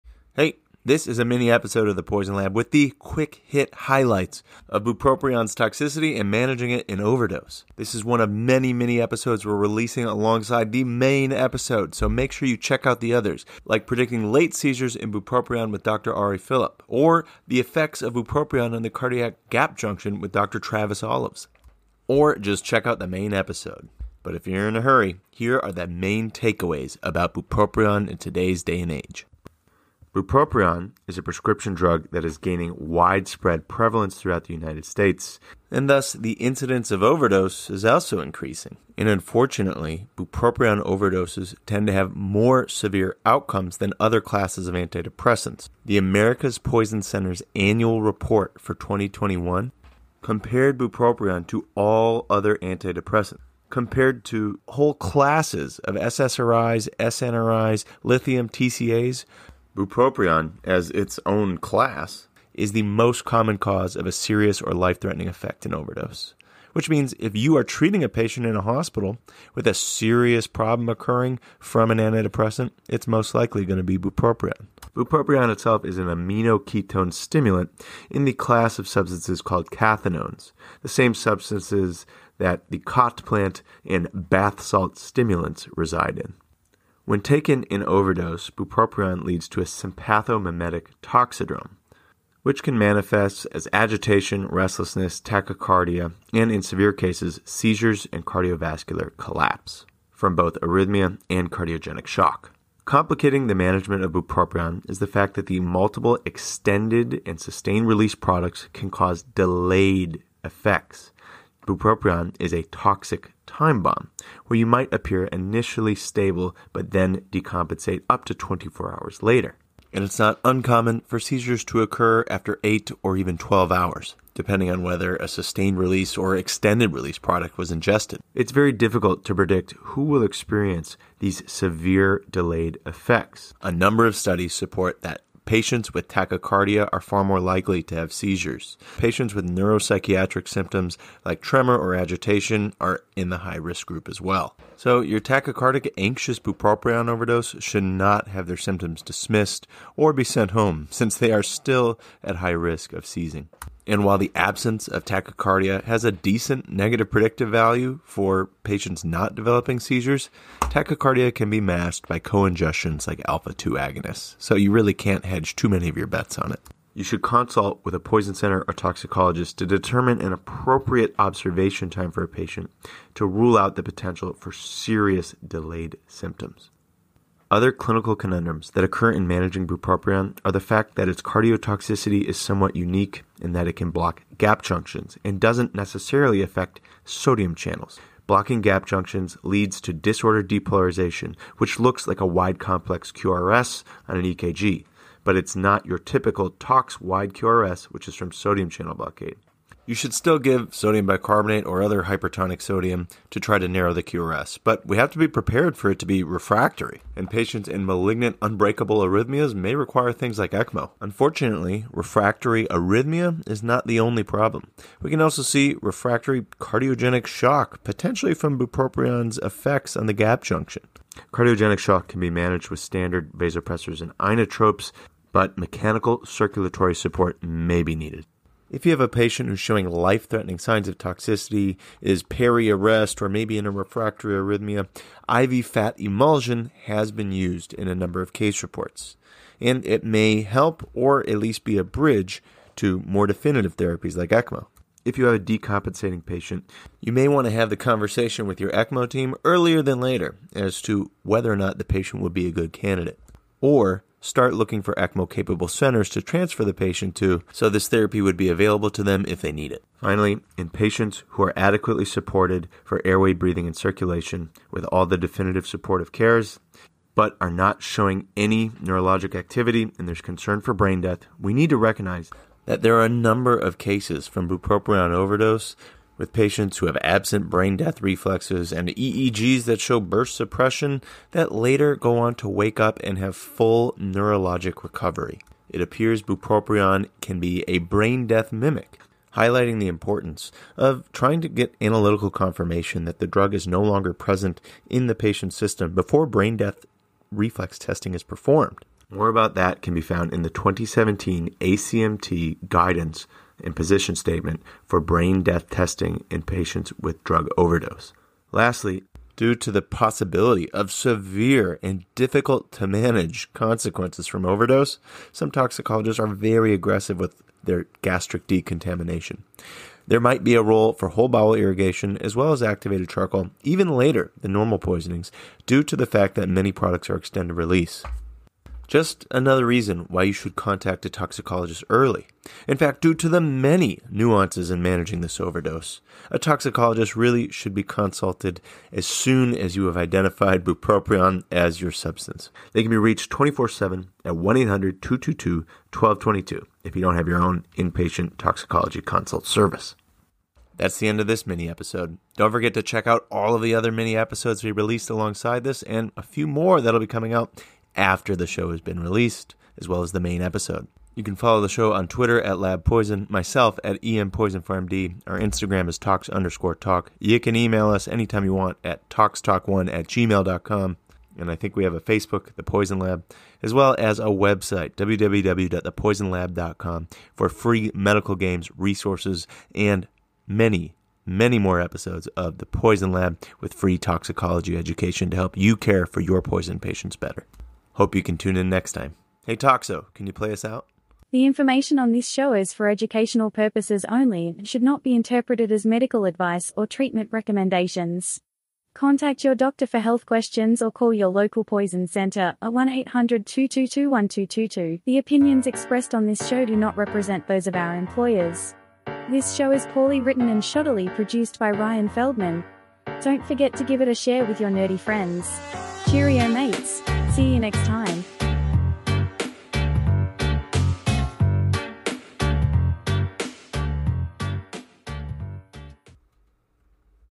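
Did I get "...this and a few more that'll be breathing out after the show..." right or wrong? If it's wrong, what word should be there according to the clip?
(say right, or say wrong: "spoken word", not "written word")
wrong: "coming", not "breathing".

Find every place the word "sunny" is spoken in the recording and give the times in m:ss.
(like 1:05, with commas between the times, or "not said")
not said.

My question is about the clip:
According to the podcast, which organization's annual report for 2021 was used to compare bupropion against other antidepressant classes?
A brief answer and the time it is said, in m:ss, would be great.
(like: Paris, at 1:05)
America's Poison Center, at 0:45.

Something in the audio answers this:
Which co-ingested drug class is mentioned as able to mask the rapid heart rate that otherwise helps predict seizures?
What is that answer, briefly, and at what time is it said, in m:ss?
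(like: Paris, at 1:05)
Alpha 2 agonists, at 2:43.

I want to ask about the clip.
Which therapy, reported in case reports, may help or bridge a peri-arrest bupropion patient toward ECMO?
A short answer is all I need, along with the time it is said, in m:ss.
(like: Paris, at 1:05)
IV fat emulsion, at 3:55.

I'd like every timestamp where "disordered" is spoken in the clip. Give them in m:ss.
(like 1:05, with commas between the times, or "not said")
3:09.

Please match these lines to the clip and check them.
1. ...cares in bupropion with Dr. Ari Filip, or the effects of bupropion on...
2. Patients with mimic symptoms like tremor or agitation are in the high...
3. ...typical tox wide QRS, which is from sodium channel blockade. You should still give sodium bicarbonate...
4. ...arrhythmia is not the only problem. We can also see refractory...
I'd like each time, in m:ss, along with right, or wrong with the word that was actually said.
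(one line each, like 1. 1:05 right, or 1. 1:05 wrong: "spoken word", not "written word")
1. 0:14 wrong: "seizures", not "cares"
2. 2:18 wrong: "neuropsychiatric", not "mimic"
3. 3:15 right
4. 3:32 right.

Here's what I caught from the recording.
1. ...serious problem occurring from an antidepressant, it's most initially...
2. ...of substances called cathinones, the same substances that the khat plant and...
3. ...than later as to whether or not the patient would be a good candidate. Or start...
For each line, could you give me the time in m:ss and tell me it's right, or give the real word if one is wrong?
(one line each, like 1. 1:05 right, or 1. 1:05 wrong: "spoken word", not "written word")
1. 1:09 wrong: "likely", not "initially"
2. 1:18 right
3. 4:09 right.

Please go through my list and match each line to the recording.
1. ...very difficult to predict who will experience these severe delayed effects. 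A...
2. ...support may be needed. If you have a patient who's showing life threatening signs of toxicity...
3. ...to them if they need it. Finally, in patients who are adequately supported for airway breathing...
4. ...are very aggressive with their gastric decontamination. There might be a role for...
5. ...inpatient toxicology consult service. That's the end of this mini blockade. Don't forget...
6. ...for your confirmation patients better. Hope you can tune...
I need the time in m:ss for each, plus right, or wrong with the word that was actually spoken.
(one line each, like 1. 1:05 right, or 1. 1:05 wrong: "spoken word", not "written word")
1. 2:08 right
2. 3:46 right
3. 4:18 right
4. 5:16 right
5. 5:47 wrong: "episode", not "blockade"
6. 6:26 wrong: "poison", not "confirmation".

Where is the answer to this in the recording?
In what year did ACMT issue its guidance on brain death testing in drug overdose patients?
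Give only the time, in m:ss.
5:00.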